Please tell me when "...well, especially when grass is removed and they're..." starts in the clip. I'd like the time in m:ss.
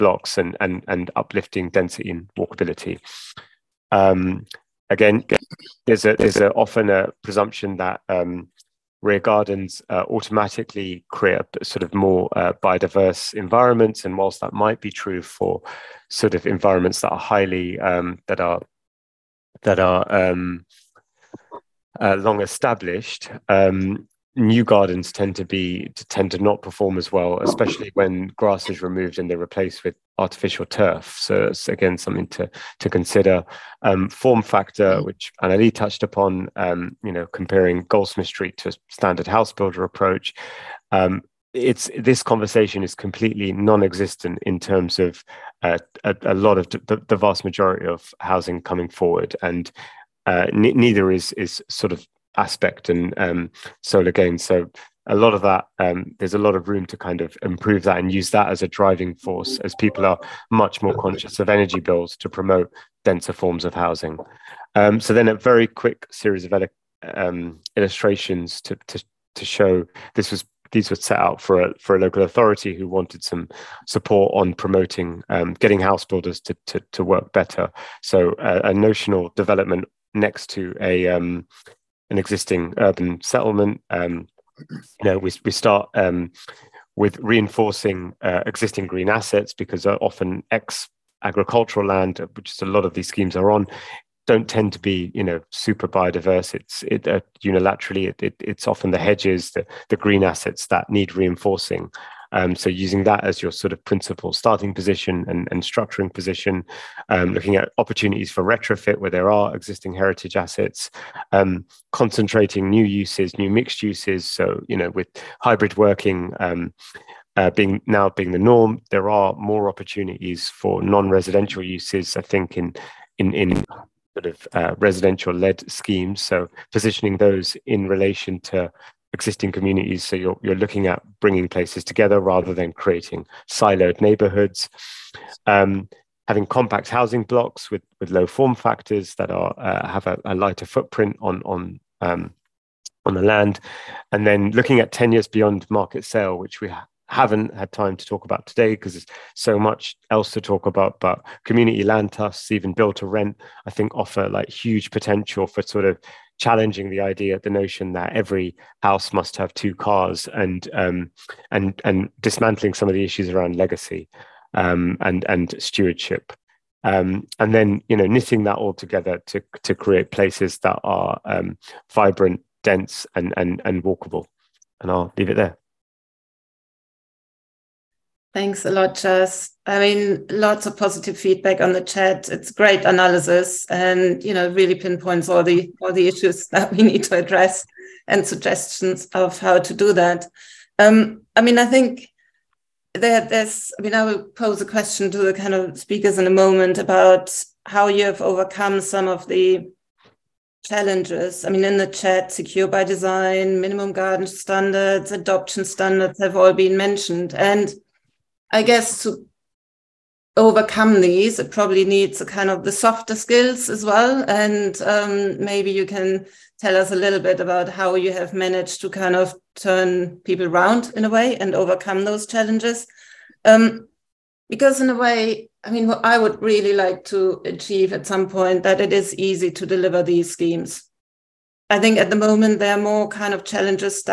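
0:27.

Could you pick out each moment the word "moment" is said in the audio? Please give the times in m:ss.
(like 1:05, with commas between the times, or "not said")
3:16, 3:52.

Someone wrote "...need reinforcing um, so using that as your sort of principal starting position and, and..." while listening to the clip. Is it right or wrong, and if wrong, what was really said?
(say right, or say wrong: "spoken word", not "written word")
right.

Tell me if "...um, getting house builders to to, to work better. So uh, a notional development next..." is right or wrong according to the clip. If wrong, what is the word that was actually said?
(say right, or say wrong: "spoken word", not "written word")
right.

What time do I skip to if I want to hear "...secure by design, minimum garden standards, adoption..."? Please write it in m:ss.
3:22.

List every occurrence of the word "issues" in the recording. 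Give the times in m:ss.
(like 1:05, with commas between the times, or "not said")
2:43, 3:06.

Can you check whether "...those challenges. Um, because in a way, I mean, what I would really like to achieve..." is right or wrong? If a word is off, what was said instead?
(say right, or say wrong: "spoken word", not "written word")
right.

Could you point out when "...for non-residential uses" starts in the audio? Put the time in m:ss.
2:00.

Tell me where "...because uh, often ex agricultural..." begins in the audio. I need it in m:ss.
1:29.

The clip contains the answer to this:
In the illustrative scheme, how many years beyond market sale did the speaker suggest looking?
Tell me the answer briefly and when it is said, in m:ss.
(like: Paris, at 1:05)
10, at 2:24.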